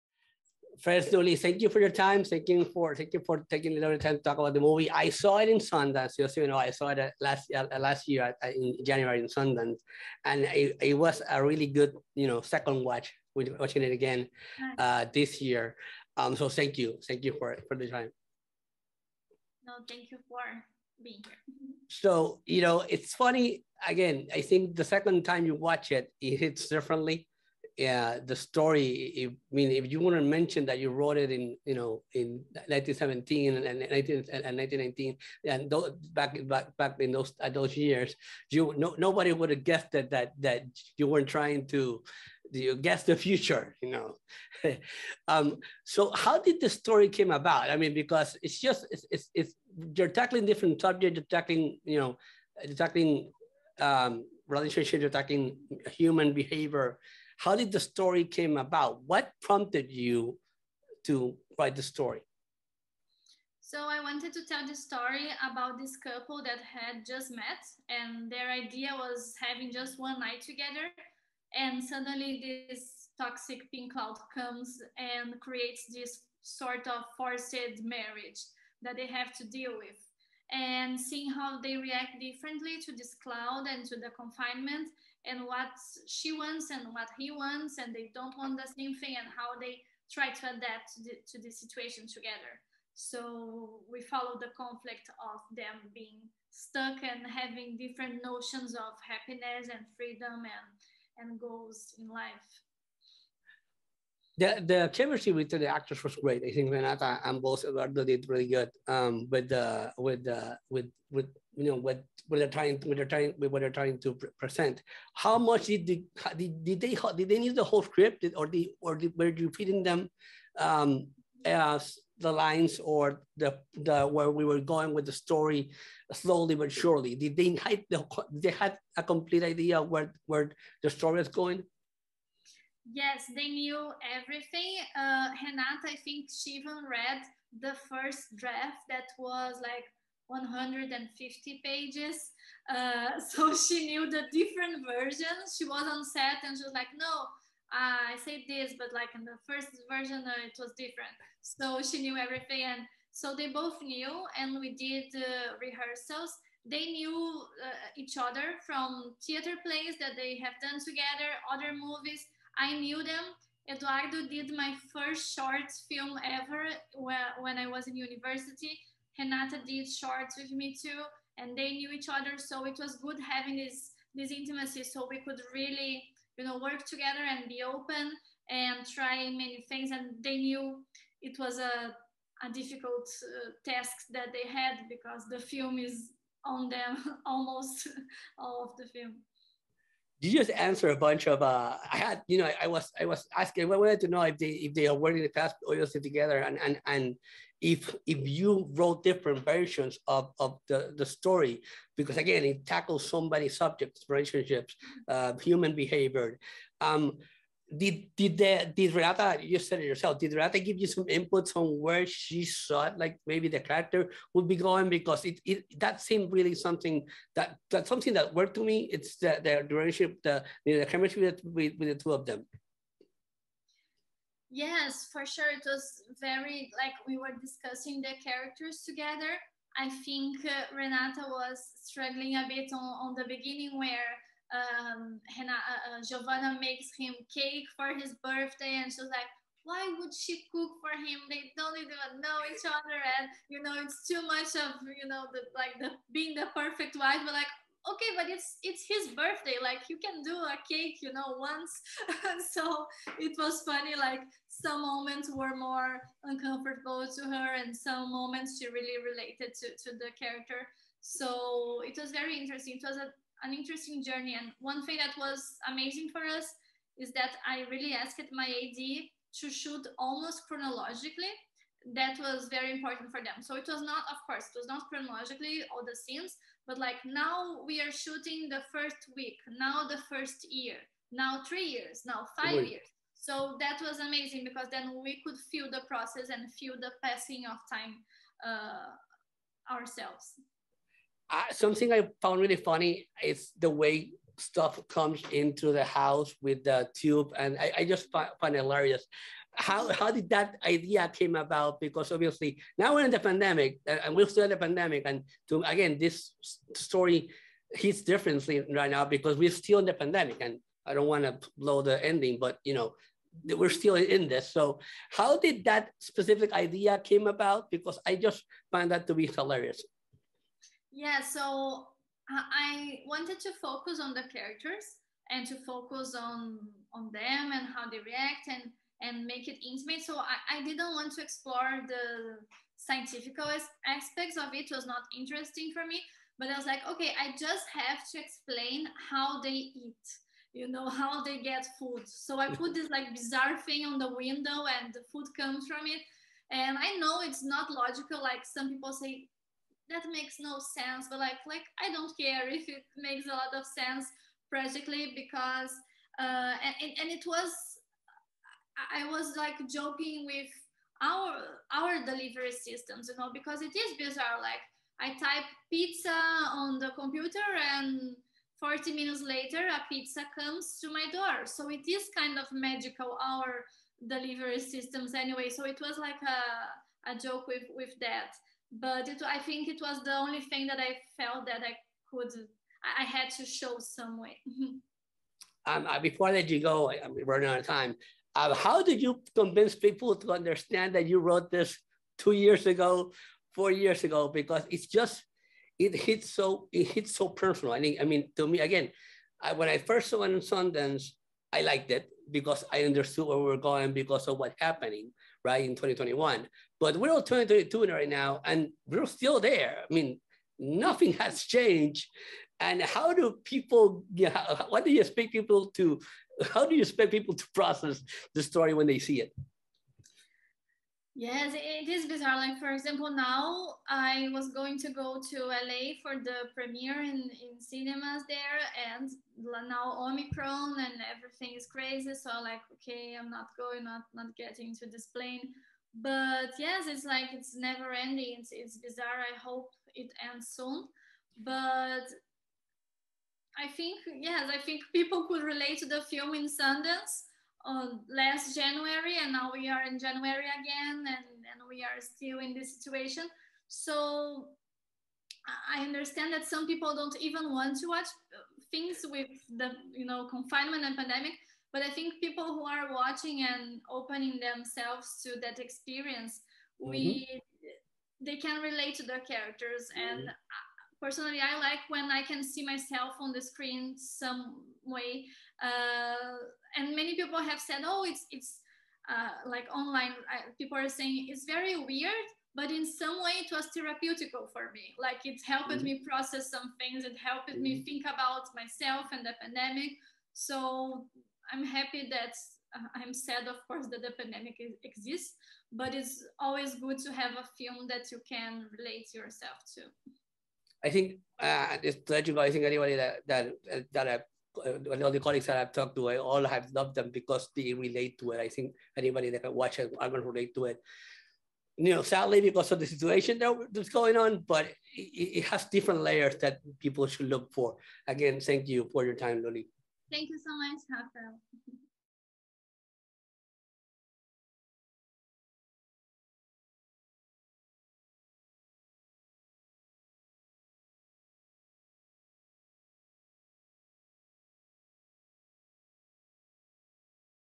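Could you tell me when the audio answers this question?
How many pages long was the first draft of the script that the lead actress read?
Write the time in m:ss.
2:20.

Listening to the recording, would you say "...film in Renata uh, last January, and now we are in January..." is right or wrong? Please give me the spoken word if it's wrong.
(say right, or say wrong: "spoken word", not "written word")
wrong: "Sundance", not "Renata".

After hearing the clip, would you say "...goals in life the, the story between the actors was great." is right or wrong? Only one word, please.
wrong.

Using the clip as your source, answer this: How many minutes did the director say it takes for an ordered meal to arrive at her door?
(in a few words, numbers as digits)
40.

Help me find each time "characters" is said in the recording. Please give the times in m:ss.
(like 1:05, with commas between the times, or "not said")
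3:33, 3:48, 4:20, 5:24, 7:49.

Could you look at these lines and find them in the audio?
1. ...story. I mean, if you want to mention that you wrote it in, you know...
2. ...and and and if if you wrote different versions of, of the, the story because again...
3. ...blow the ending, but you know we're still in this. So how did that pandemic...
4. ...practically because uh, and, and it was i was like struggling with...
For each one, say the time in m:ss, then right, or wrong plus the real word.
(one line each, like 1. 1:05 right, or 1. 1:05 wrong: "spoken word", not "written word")
1. 0:28 right
2. 3:16 right
3. 5:11 wrong: "specific", not "pandemic"
4. 5:54 wrong: "joking", not "struggling".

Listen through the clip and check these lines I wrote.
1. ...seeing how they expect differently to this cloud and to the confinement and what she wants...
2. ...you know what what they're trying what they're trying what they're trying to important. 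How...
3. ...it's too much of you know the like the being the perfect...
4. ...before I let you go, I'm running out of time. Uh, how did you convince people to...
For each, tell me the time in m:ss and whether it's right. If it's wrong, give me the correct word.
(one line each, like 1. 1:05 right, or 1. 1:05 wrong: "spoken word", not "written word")
1. 1:20 wrong: "react", not "expect"
2. 1:51 wrong: "present", not "important"
3. 4:03 right
4. 6:25 right.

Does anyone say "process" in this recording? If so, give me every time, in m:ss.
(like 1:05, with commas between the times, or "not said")
4:45, 6:57, 8:06.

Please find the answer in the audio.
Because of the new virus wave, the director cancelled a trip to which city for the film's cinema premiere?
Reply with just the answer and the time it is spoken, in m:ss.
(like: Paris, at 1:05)
LA, at 7:05.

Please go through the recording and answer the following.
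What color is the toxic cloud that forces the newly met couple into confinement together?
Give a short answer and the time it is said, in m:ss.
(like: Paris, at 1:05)
pink, at 1:13.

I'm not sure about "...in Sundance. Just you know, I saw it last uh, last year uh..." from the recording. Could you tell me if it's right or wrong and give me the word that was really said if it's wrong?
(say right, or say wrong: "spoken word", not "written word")
right.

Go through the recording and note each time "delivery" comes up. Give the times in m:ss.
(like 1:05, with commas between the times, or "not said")
6:02, 6:14.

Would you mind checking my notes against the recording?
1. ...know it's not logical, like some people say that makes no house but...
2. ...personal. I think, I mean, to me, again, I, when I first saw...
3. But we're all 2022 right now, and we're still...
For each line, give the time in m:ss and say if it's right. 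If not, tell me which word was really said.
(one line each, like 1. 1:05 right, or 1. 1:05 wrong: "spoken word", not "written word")
1. 5:46 wrong: "sense", not "house"
2. 6:37 right
3. 6:46 right.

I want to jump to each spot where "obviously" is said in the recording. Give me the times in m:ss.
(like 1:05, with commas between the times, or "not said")
3:15, 5:02.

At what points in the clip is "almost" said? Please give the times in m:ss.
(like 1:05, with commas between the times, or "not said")
3:07, 4:29.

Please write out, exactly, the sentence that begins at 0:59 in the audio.
What prompted you to write the story?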